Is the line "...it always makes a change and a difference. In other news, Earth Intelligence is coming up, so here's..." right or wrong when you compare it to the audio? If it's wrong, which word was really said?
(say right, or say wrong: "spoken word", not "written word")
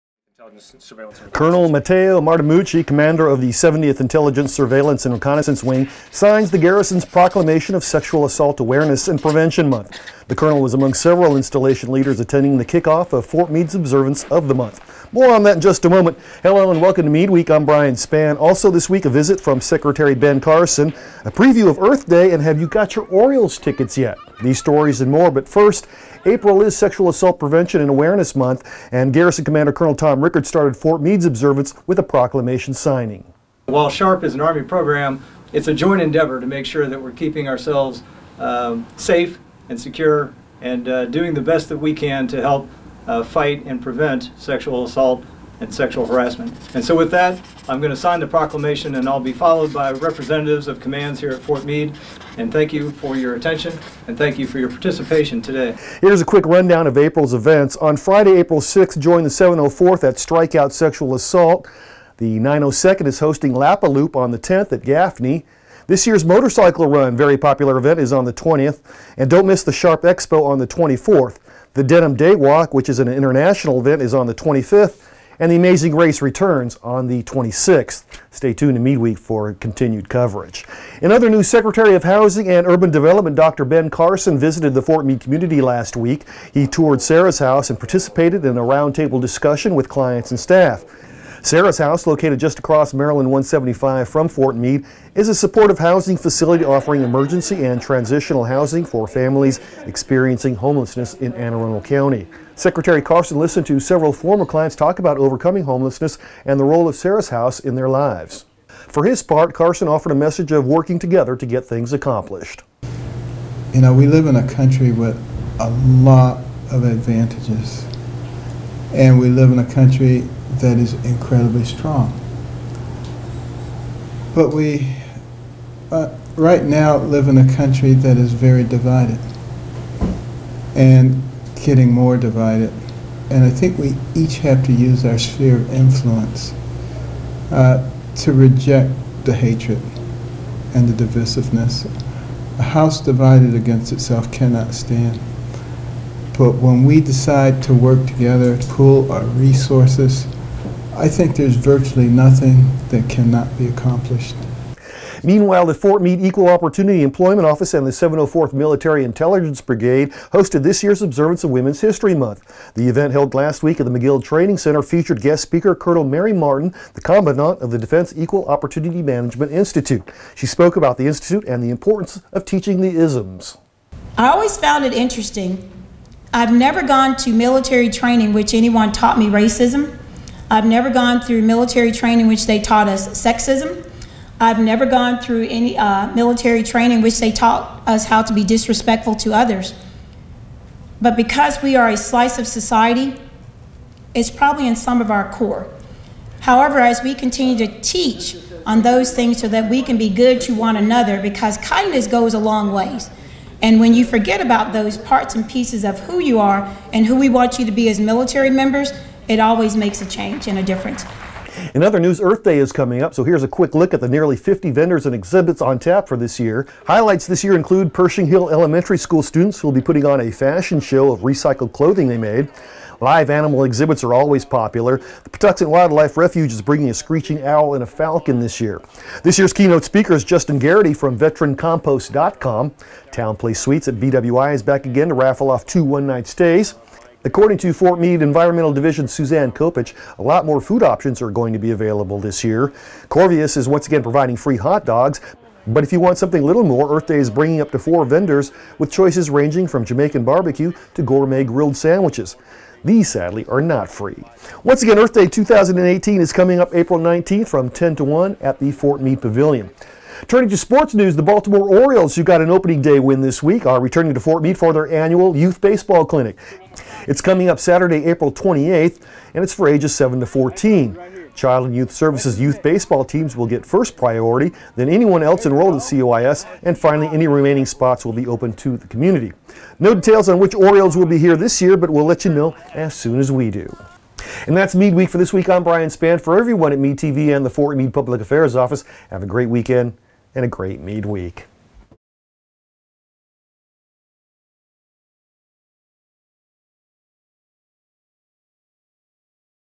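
wrong: "Day", not "Intelligence".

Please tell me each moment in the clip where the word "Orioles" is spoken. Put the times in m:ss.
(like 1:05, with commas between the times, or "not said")
0:23, 4:21, 4:40.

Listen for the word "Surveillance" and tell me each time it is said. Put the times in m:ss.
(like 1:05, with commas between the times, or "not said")
0:04.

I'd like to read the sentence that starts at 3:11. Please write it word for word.
But because we are a slice of society, it's probably in some of our core.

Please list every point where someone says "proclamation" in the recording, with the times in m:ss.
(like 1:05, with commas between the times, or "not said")
0:07, 0:32, 0:48.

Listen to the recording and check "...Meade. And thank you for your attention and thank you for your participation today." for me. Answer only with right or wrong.
right.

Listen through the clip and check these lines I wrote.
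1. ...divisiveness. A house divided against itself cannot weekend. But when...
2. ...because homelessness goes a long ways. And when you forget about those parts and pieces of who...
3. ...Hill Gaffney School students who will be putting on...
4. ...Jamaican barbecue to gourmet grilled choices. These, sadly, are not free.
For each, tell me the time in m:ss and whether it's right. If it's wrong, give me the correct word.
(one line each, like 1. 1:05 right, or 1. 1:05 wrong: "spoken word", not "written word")
1. 2:21 wrong: "stand", not "weekend"
2. 3:21 wrong: "kindness", not "homelessness"
3. 3:38 wrong: "Elementary", not "Gaffney"
4. 4:09 wrong: "sandwiches", not "choices".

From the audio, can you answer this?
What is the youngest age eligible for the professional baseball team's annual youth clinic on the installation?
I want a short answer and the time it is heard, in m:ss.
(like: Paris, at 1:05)
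7, at 4:29.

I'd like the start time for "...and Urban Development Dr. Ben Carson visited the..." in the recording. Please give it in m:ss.
1:22.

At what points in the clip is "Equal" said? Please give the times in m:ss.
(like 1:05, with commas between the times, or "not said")
2:36, 2:48.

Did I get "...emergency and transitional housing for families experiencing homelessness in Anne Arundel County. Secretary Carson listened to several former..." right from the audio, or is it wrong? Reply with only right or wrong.
right.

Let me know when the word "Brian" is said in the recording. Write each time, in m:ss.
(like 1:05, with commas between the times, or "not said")
0:17, 4:45.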